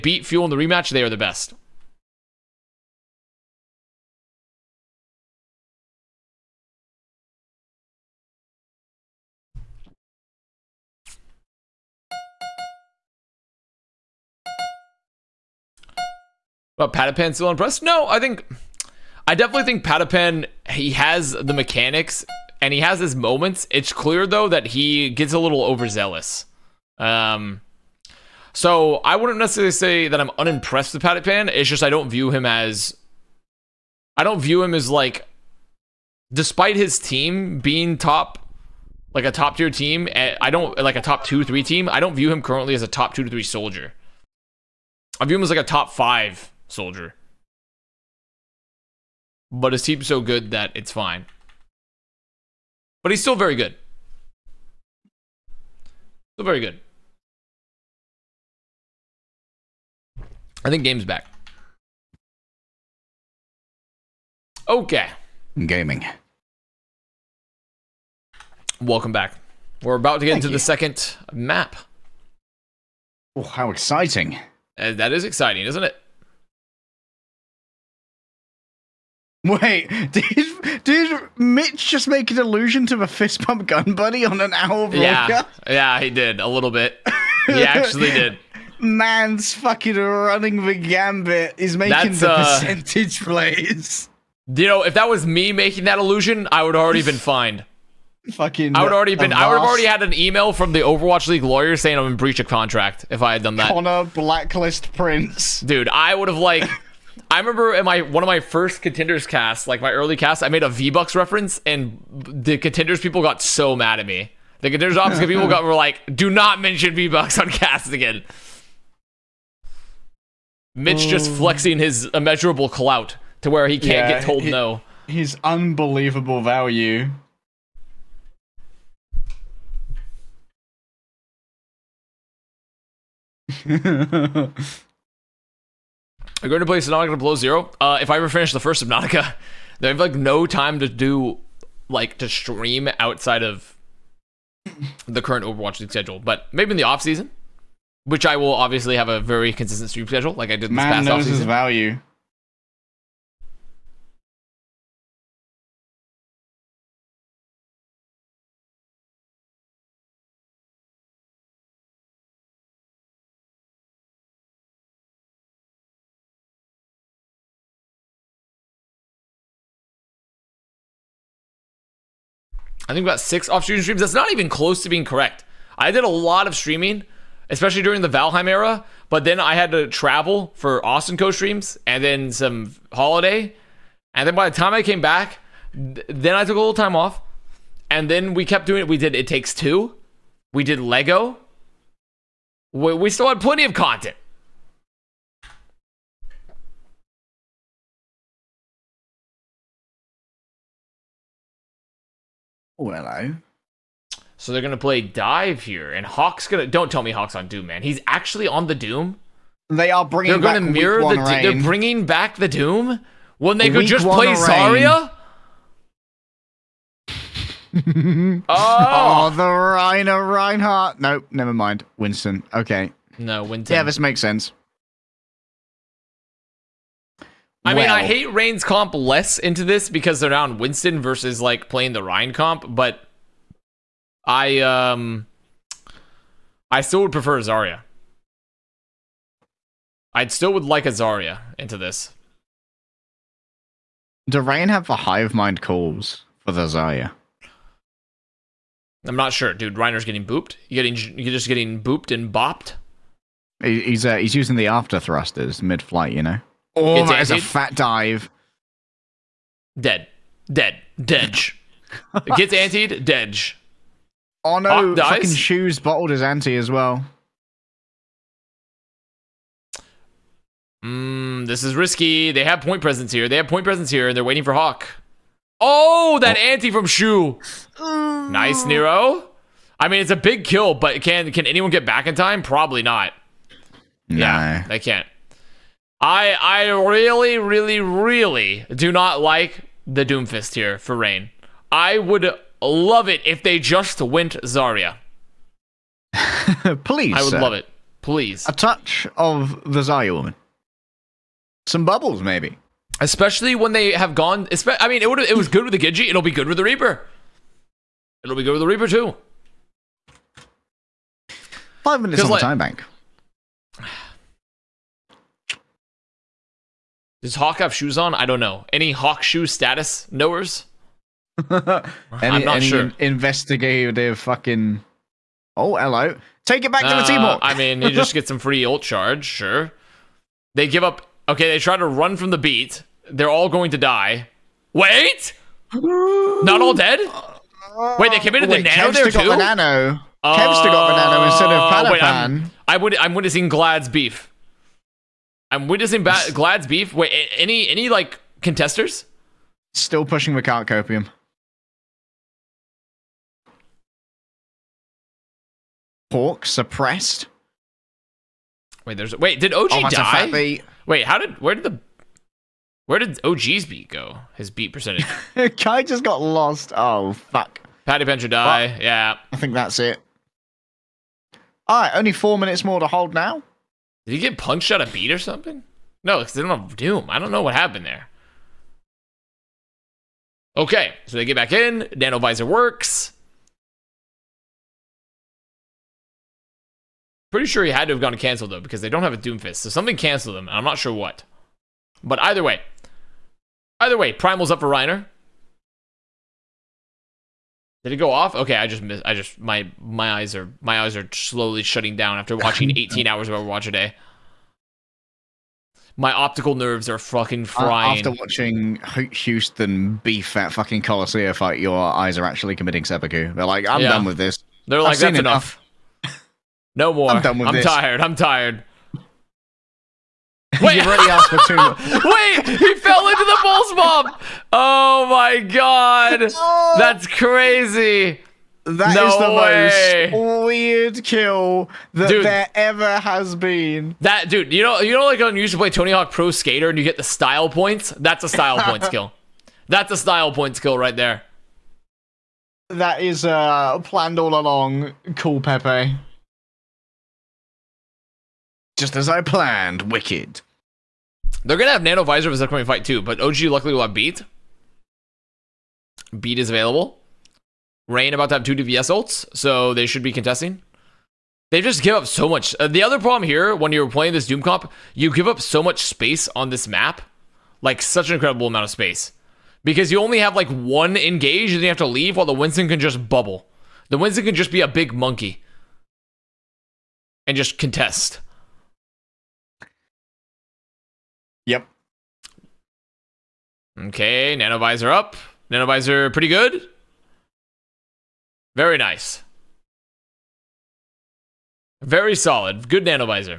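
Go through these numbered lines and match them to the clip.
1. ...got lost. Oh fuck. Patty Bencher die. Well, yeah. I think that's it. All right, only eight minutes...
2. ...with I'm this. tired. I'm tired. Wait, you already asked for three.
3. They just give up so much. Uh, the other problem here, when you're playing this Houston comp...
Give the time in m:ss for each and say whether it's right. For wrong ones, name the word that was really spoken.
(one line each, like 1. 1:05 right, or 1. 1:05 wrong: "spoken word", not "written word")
1. 6:06 wrong: "four", not "eight"
2. 6:57 wrong: "two", not "three"
3. 7:41 wrong: "Doom", not "Houston".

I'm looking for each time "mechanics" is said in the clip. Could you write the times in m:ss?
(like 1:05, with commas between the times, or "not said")
0:21.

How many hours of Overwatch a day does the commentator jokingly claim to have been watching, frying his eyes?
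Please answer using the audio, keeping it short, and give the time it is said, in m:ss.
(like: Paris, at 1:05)
18, at 6:42.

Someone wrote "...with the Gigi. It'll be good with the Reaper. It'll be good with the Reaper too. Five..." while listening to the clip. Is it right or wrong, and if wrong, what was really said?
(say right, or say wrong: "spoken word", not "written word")
right.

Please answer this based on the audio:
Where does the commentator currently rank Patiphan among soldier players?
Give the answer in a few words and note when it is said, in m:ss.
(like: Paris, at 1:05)
top 5, at 0:45.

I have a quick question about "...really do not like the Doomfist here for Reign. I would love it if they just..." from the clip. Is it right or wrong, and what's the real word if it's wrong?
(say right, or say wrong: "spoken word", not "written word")
right.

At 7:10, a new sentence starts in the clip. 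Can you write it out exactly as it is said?
most weird kill that dude, there ever has been.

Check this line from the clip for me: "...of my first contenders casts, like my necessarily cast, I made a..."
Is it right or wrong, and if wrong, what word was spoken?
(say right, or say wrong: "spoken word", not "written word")
wrong: "early", not "necessarily".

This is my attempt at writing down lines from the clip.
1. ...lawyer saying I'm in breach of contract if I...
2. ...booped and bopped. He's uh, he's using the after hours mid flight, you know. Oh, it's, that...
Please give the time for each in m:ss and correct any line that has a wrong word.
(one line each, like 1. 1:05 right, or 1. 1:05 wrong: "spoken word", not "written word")
1. 1:41 right
2. 4:11 wrong: "thrusters", not "hours".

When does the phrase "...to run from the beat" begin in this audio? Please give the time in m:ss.
5:31.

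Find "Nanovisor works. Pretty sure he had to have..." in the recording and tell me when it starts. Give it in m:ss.
6:21.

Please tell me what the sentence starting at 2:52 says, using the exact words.
I think about six off-stream streams.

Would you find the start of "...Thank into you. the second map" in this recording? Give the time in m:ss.
1:10.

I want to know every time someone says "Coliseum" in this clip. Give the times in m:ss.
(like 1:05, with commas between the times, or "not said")
6:50.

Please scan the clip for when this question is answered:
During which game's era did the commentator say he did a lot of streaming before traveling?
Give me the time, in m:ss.
2:58.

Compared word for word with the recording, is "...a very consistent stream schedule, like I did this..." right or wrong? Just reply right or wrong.
right.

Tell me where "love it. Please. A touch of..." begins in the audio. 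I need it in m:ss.
4:57.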